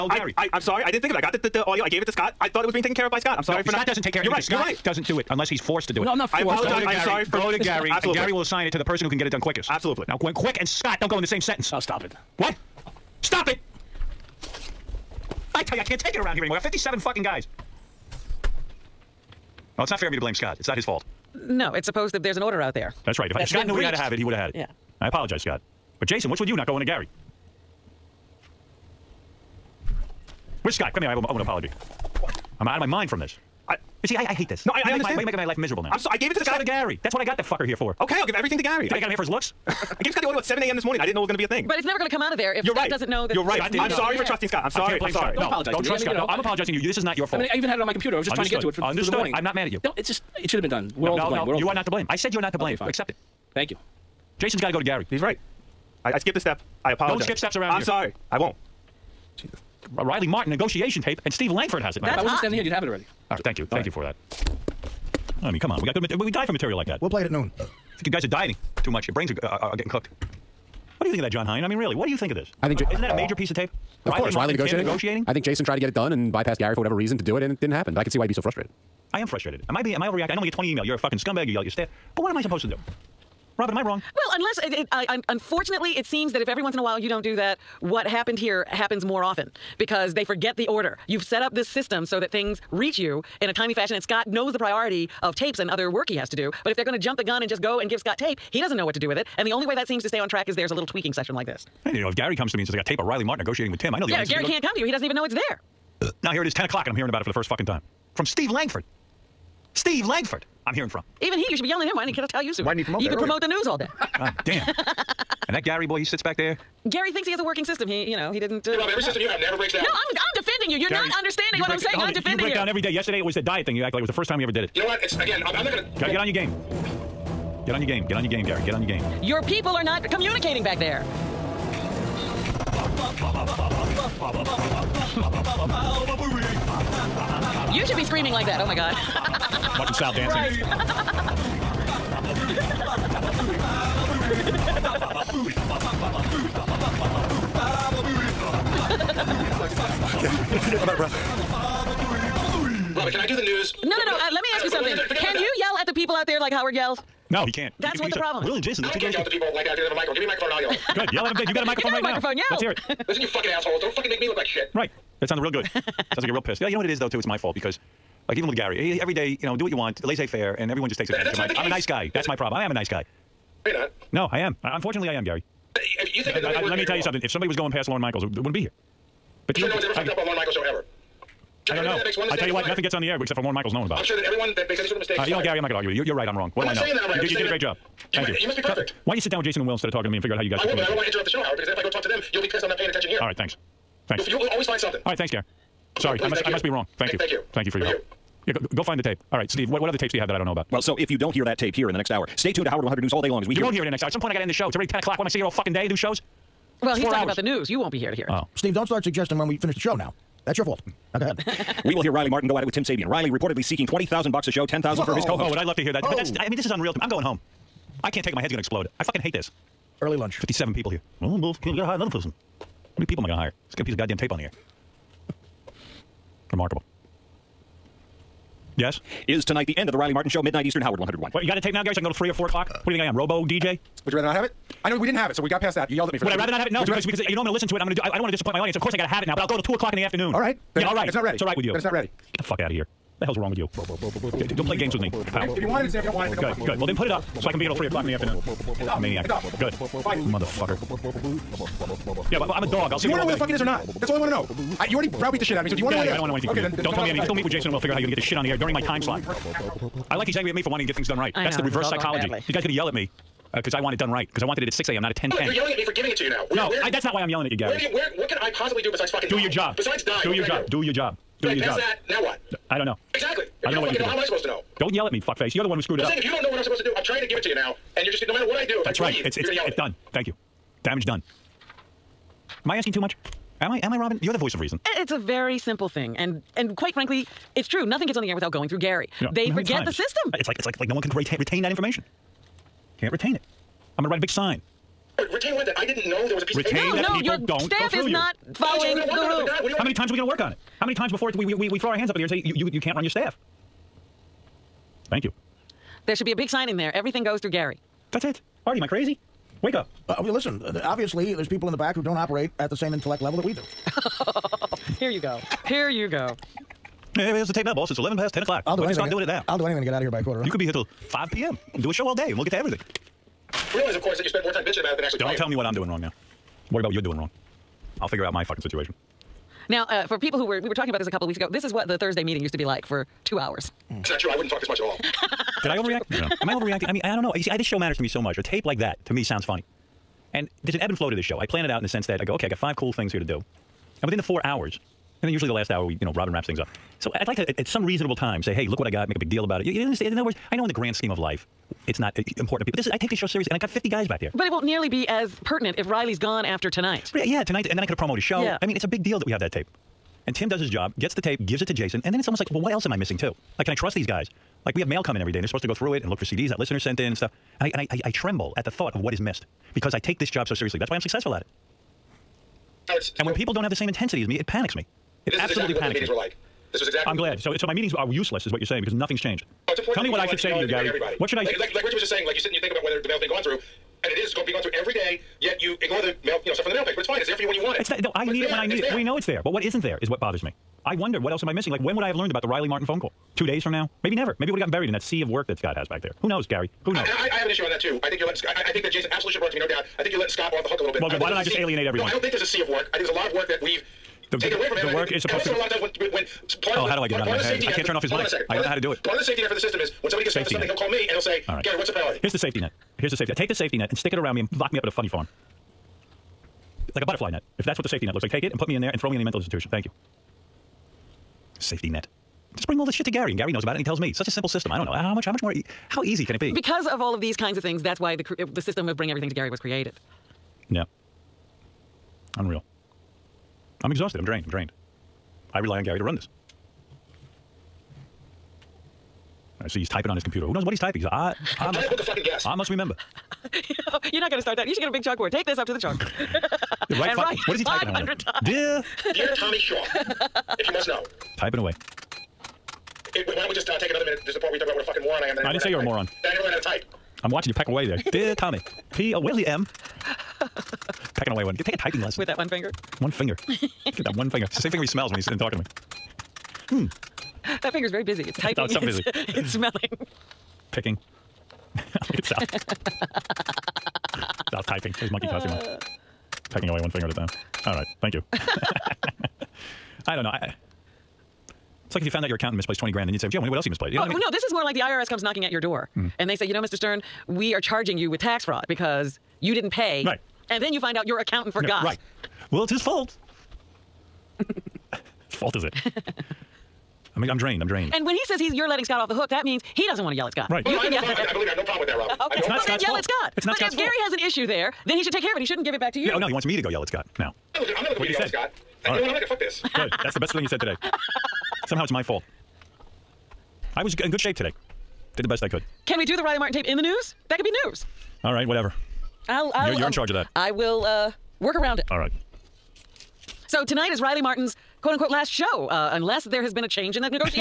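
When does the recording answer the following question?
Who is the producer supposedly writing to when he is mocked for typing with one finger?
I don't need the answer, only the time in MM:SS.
07:29.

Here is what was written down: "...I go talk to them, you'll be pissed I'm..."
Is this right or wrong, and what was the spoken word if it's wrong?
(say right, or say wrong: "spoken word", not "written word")
right.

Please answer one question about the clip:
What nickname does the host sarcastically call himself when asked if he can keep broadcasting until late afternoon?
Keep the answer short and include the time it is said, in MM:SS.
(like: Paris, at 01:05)
robo DJ, at 03:53.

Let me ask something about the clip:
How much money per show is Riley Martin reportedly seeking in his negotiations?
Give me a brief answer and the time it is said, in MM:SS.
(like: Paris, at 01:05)
$20,000, at 03:33.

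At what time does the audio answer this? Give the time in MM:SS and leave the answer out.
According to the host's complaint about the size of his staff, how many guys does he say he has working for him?
00:16.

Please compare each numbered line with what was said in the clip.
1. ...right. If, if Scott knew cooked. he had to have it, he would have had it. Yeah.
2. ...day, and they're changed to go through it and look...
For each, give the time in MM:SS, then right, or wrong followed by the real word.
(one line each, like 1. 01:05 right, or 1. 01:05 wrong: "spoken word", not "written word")
1. 00:23 wrong: "breached", not "cooked"
2. 06:05 wrong: "supposed", not "changed".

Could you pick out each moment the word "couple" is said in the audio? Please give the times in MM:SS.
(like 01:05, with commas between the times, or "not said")
05:31.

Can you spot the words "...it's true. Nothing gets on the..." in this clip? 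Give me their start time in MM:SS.
04:47.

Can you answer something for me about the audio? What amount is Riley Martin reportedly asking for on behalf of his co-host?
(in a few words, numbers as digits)
$10,000.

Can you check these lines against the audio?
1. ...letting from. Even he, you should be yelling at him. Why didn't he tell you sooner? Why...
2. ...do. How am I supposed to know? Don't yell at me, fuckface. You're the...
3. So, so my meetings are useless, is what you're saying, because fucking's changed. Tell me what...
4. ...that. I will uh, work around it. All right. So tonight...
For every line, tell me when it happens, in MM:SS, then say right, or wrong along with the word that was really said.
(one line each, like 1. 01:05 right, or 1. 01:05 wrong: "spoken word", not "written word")
1. 01:50 wrong: "hearing", not "letting"
2. 04:33 right
3. 06:17 wrong: "nothing", not "fucking"
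4. 08:40 right.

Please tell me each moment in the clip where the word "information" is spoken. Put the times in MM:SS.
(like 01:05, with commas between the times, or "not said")
04:51.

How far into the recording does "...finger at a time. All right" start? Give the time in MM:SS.
07:56.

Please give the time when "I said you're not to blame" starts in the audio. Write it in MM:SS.
00:52.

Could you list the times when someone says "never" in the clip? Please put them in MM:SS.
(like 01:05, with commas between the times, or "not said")
00:41, 01:59, 06:34, 07:36.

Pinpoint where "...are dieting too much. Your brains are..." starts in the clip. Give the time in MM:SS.
01:08.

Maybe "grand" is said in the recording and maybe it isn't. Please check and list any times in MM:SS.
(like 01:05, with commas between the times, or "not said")
05:50, 08:02.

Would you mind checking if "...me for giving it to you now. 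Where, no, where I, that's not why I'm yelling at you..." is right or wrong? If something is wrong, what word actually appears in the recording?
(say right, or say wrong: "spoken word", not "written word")
right.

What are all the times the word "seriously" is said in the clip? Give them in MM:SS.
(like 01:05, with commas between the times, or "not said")
05:53, 06:10.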